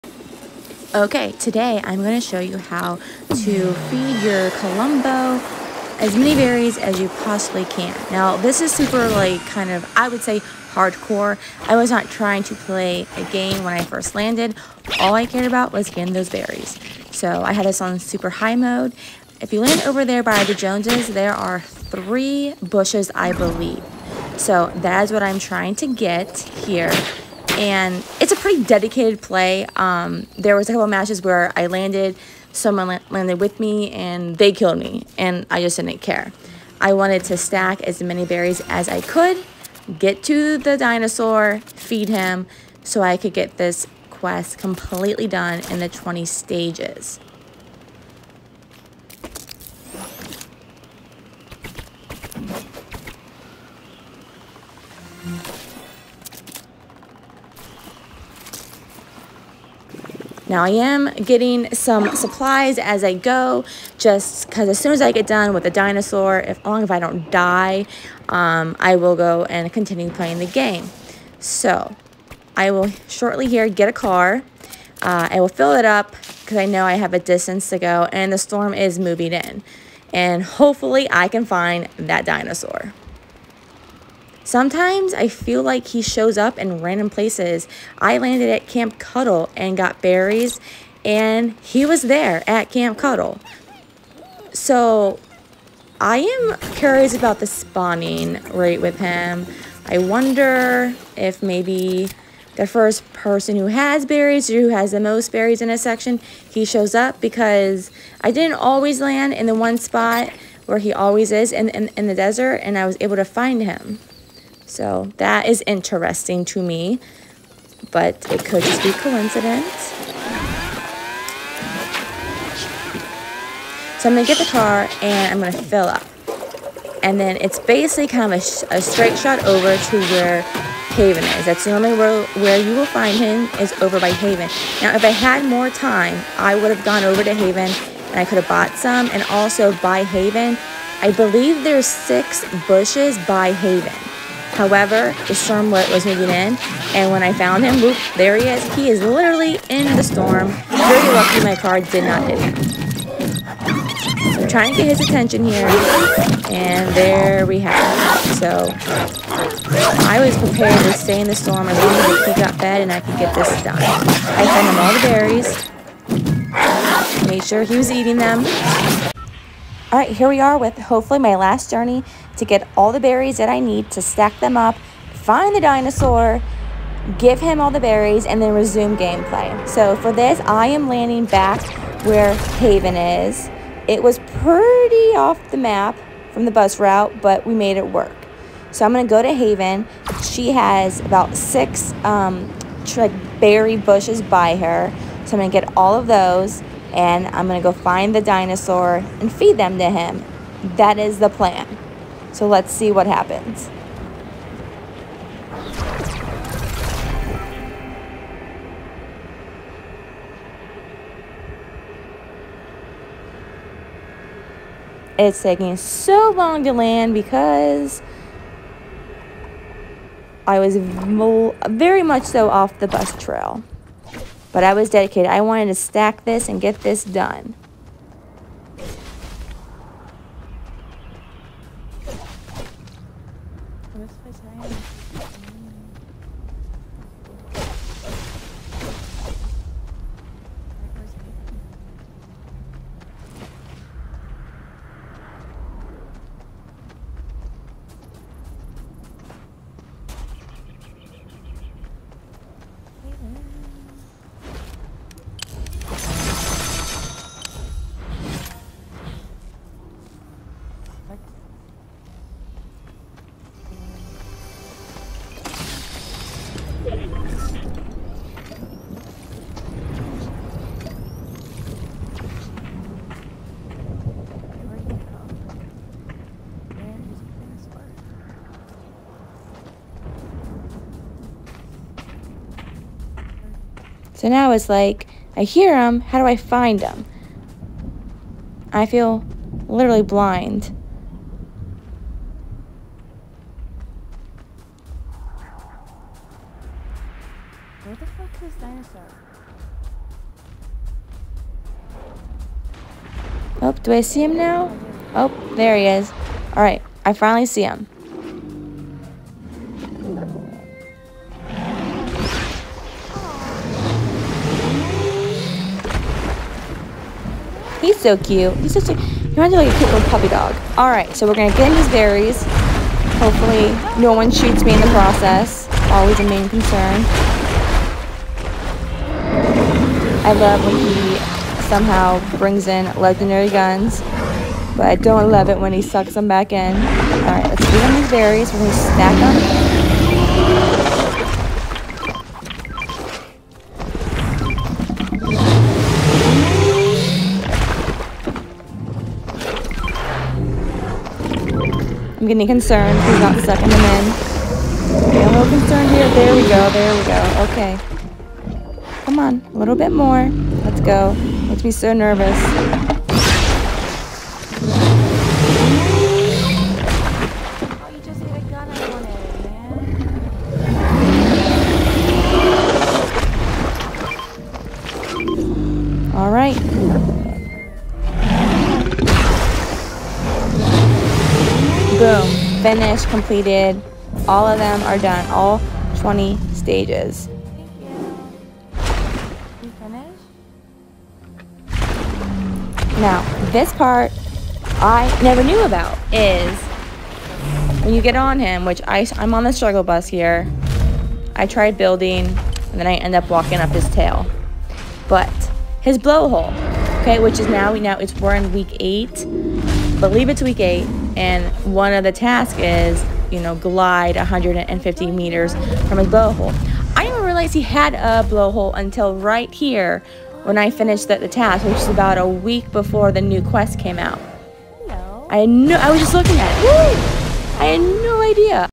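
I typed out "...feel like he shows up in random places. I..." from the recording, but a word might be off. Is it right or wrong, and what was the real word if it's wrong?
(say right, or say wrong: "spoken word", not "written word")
right.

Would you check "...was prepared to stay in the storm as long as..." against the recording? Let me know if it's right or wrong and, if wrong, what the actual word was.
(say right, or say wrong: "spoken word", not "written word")
right.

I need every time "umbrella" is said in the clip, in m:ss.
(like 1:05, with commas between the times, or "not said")
not said.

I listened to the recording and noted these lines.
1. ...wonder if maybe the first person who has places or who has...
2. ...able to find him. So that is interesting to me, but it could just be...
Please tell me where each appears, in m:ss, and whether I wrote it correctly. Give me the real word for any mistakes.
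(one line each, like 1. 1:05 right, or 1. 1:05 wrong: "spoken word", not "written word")
1. 1:39 wrong: "berries", not "places"
2. 1:52 right.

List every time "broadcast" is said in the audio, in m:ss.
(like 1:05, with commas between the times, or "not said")
not said.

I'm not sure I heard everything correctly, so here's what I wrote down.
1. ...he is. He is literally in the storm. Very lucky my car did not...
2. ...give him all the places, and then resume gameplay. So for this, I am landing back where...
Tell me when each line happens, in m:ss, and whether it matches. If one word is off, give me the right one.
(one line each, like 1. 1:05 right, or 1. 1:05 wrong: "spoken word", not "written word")
1. 2:28 right
2. 2:57 wrong: "berries", not "places".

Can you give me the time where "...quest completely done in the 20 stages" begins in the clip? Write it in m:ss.
0:44.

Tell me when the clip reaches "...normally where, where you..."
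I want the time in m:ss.
2:11.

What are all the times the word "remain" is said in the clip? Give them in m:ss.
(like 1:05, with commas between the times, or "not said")
not said.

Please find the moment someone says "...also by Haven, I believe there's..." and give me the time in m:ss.
2:19.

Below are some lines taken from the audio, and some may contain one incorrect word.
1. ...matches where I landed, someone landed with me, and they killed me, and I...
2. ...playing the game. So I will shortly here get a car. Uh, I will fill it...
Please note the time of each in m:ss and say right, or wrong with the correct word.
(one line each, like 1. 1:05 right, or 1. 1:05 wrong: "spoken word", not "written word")
1. 0:30 right
2. 1:10 right.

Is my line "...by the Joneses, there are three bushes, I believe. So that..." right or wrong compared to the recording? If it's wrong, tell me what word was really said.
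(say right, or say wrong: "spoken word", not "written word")
right.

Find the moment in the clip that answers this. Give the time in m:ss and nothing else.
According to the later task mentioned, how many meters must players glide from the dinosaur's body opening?
6:54.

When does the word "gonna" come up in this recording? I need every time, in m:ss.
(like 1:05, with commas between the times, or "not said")
3:17, 5:21, 5:38.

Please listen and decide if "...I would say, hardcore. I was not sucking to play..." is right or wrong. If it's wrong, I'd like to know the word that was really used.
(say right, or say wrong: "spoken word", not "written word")
wrong: "trying", not "sucking".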